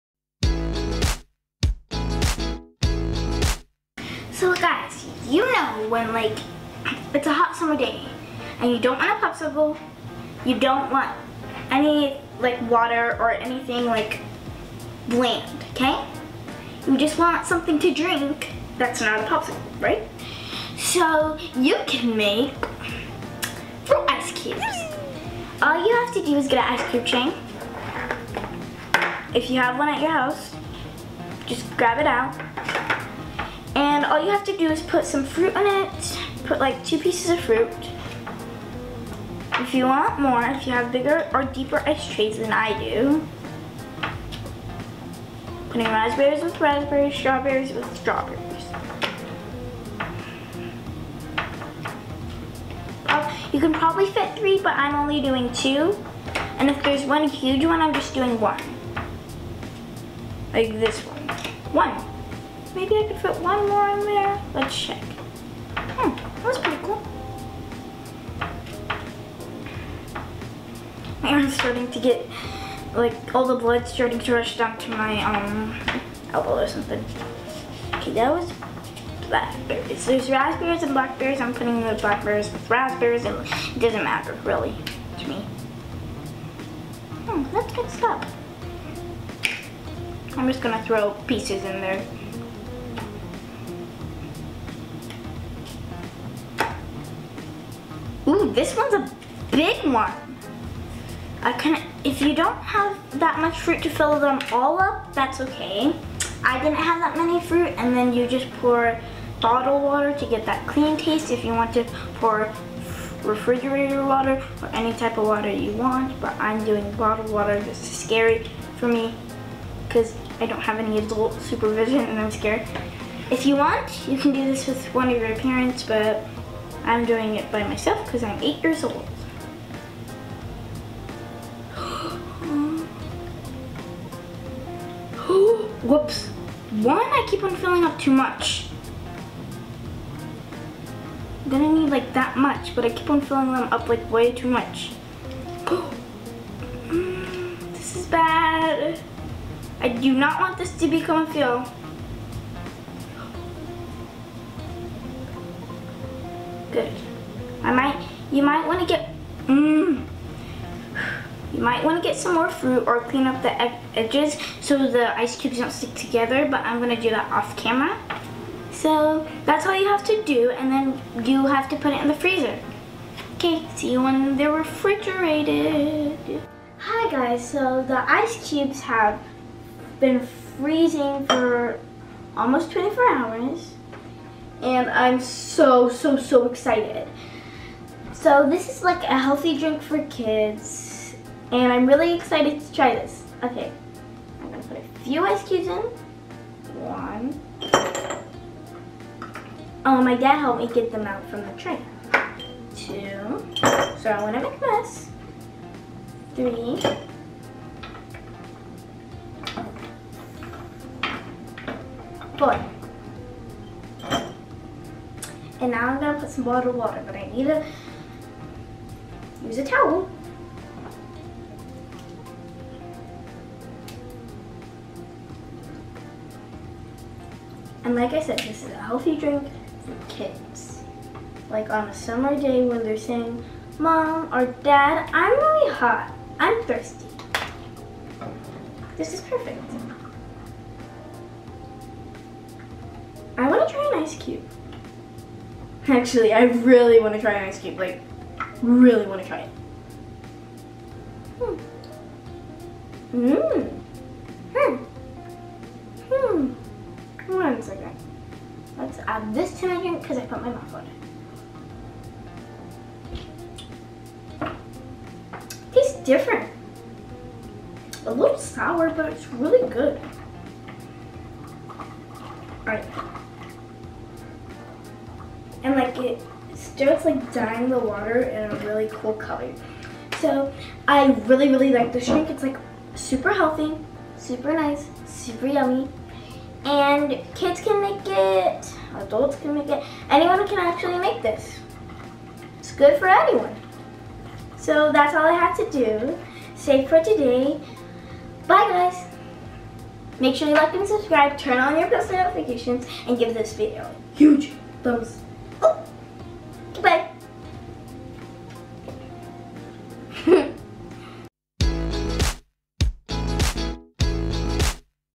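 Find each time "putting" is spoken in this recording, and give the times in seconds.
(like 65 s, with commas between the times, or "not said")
45 s, 81 s.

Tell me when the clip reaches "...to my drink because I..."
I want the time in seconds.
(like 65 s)
259 s.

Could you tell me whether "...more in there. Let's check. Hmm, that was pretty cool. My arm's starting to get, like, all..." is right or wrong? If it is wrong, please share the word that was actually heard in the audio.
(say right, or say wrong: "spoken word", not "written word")
right.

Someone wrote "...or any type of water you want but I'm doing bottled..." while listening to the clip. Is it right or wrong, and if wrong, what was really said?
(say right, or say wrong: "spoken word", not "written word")
right.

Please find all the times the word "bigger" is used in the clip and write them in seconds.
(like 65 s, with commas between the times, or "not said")
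40 s.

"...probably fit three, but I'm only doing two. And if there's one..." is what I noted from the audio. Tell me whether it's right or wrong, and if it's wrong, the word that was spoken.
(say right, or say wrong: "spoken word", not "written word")
right.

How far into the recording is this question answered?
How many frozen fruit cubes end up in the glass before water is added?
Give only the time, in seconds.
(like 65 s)
212 s.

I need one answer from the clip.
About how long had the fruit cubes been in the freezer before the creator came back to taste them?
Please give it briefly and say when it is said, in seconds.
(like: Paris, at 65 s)
Almost 24 hours, at 182 s.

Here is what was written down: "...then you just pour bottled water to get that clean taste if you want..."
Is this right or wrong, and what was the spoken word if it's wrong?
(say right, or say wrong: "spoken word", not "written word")
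right.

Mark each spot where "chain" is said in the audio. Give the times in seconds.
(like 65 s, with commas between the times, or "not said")
27 s.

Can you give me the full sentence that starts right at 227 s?
And like I said, this is a healthy drink for kids.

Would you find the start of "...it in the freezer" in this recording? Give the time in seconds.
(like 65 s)
171 s.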